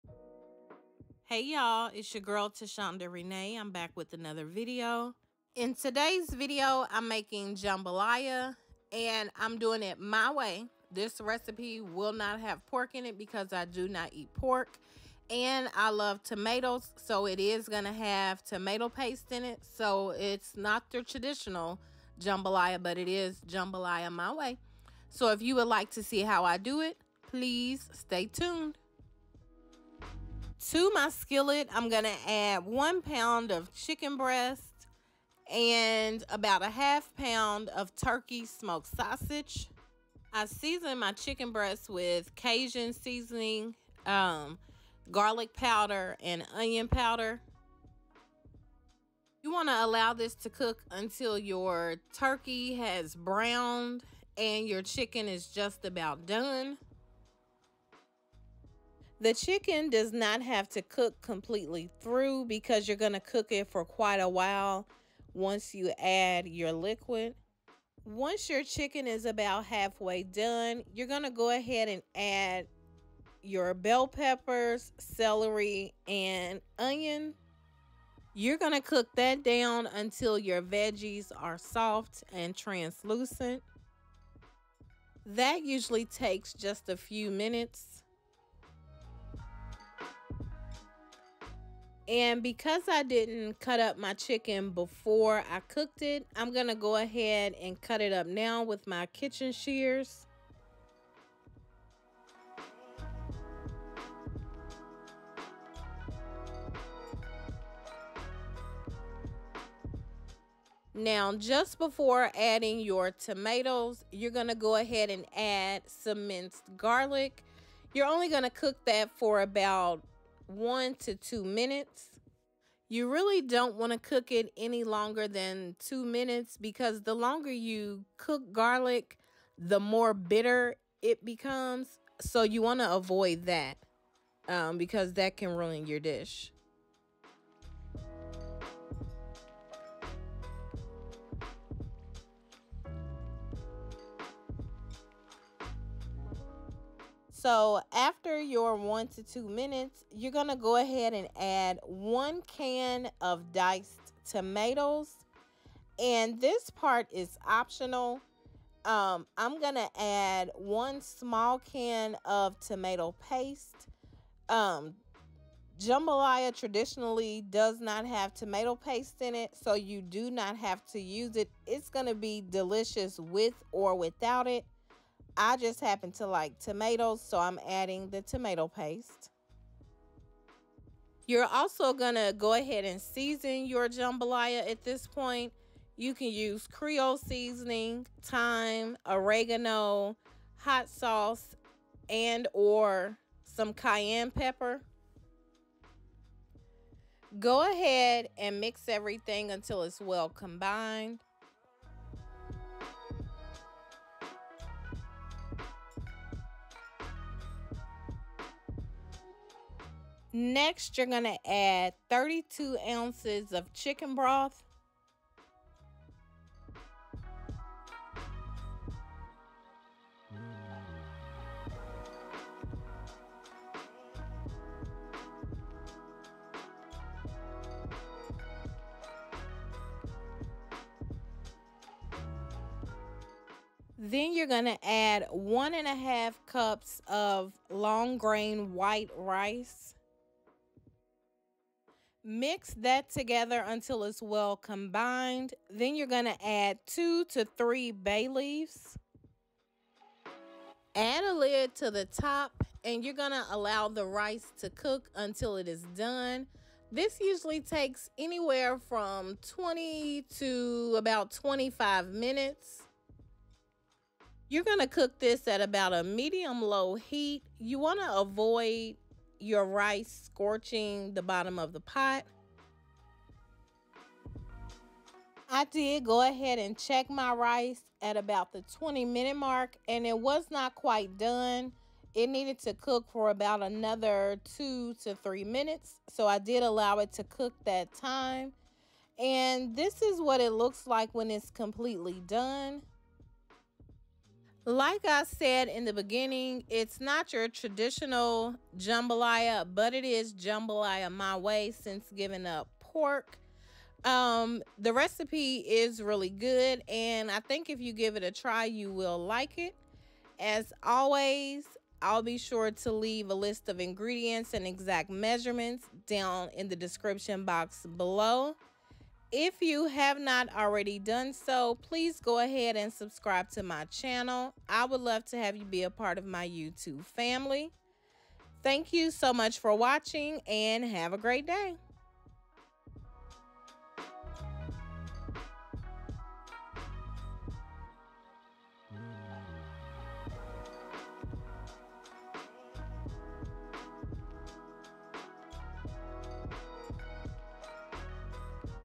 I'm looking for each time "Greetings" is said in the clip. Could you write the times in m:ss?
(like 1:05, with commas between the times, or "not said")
not said.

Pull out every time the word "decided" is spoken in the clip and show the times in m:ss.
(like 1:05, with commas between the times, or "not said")
not said.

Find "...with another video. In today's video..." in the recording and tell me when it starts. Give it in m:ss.
0:03.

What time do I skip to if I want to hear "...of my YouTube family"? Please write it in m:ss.
5:26.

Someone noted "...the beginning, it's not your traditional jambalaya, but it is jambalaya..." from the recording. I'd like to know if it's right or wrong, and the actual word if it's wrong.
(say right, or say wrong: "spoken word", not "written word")
right.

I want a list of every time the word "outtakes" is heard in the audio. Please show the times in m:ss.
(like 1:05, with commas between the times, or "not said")
not said.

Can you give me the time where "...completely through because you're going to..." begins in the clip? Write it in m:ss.
1:01.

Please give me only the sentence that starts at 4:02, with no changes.
Mix that together until it's well combined.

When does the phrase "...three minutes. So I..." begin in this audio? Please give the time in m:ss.
4:45.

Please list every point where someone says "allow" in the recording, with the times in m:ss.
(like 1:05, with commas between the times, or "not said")
0:49, 4:13, 4:46.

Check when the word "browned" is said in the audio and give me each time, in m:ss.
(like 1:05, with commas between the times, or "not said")
0:53.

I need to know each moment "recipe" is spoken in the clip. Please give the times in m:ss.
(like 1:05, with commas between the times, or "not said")
0:11, 5:04.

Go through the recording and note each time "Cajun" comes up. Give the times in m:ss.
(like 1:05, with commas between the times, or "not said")
0:42.